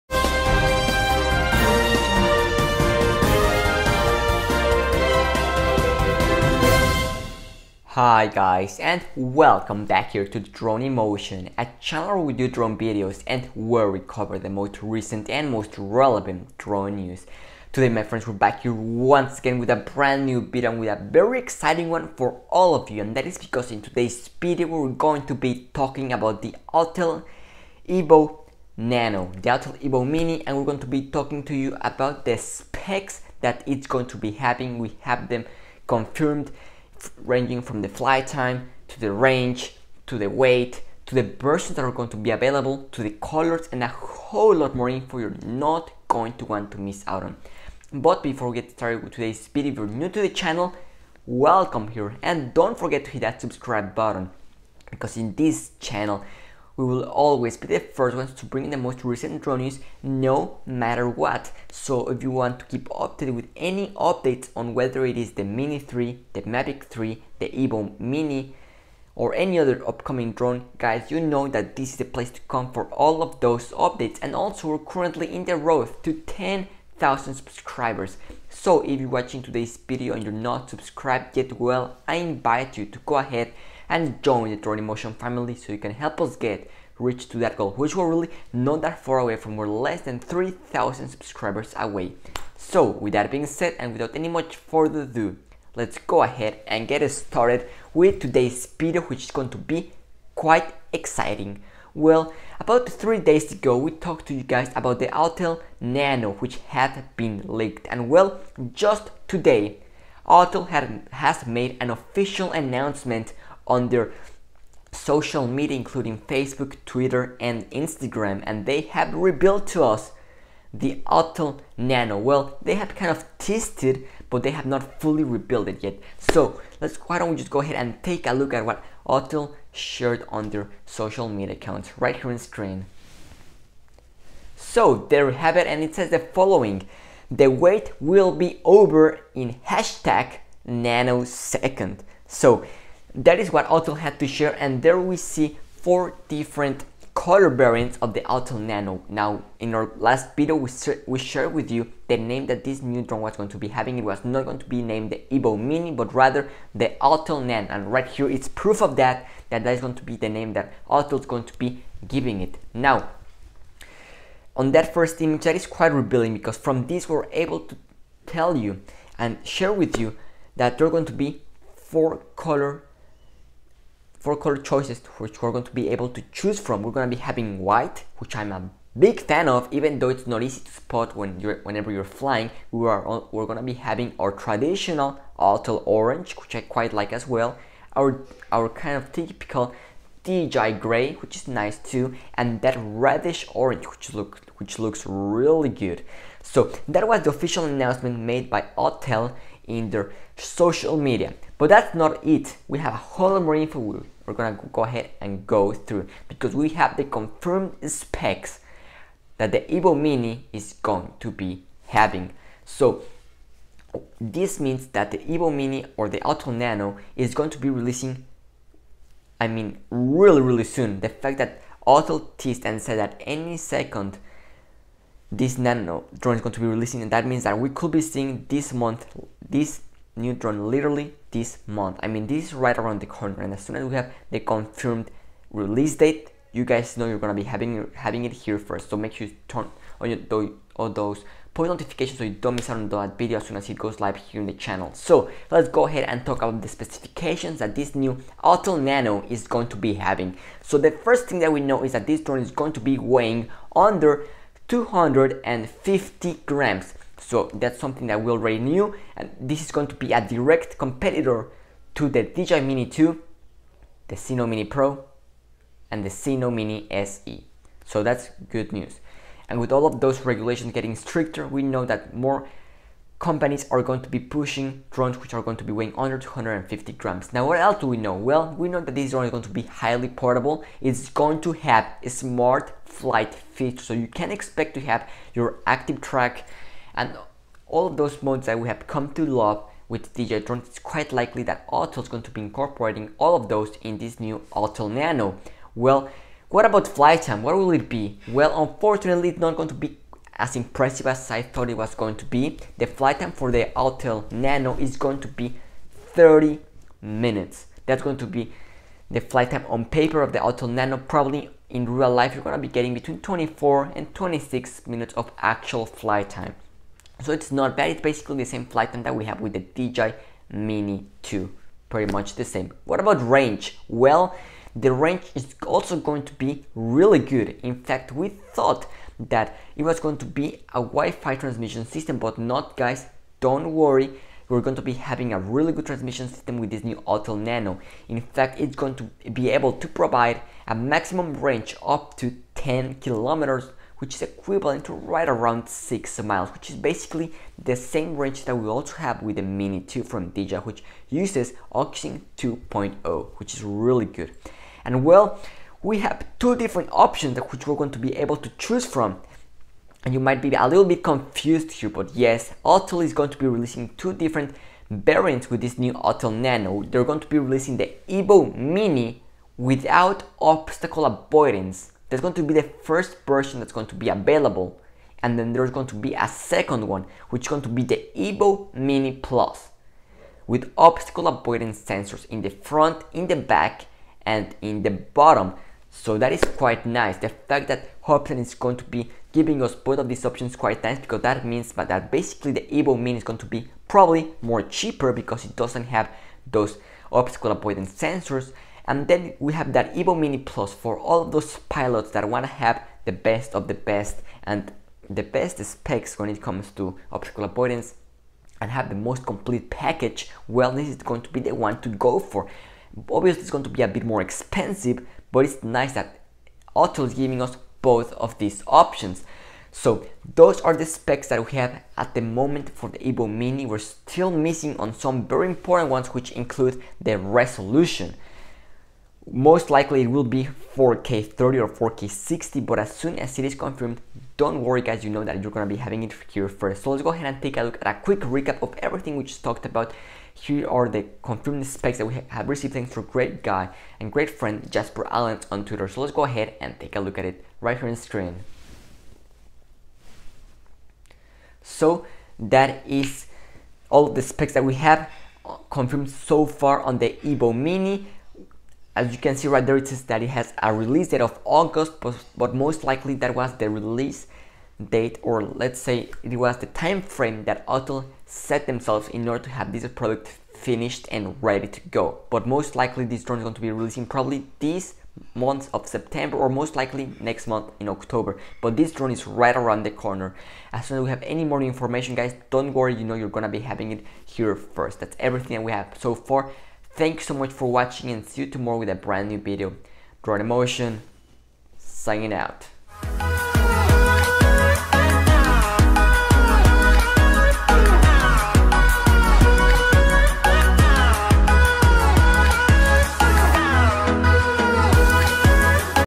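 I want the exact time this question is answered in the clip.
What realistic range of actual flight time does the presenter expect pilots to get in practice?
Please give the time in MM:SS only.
05:12.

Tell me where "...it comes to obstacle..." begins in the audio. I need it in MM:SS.
06:46.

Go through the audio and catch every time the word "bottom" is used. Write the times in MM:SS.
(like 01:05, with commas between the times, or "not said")
06:24.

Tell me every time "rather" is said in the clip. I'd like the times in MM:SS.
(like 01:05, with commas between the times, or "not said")
02:36.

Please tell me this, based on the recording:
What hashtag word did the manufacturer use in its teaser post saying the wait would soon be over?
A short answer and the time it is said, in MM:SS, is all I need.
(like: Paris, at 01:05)
nanosecond, at 02:20.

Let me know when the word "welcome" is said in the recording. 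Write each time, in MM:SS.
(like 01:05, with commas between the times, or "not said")
00:09, 00:51.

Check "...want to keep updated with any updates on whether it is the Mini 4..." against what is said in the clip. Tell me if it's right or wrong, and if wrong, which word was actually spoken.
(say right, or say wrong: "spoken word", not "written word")
wrong: "3", not "4".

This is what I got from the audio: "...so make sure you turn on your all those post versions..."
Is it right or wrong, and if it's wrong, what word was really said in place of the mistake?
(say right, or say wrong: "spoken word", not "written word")
wrong: "notifications", not "versions".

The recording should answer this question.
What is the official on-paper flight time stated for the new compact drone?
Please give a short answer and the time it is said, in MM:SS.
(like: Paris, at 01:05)
30 minutes, at 05:06.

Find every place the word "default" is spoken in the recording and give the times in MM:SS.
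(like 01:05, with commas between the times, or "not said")
not said.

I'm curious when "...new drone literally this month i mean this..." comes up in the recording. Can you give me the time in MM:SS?
03:50.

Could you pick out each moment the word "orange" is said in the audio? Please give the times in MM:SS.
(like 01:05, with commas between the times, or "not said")
03:05, 03:13.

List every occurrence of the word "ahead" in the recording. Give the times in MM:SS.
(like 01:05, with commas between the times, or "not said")
01:23, 01:36, 02:07, 03:24, 04:05, 07:17, 07:26.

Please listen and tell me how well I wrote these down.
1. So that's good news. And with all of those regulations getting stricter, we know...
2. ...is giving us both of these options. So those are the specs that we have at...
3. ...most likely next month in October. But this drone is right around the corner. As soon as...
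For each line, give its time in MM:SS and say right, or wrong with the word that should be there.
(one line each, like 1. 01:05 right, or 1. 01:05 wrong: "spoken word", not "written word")
1. 04:27 right
2. 06:57 right
3. 07:56 right.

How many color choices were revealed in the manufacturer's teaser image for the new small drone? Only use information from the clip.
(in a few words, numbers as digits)
4.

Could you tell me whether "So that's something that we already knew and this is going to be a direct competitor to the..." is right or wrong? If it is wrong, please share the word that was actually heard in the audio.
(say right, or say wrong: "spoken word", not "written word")
right.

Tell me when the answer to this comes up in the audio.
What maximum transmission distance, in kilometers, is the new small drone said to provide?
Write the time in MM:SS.
05:42.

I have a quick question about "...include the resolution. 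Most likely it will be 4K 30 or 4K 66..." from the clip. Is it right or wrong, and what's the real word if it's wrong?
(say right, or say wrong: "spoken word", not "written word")
wrong: "60", not "66".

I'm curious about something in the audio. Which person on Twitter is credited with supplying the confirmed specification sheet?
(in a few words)
Jasper Allen.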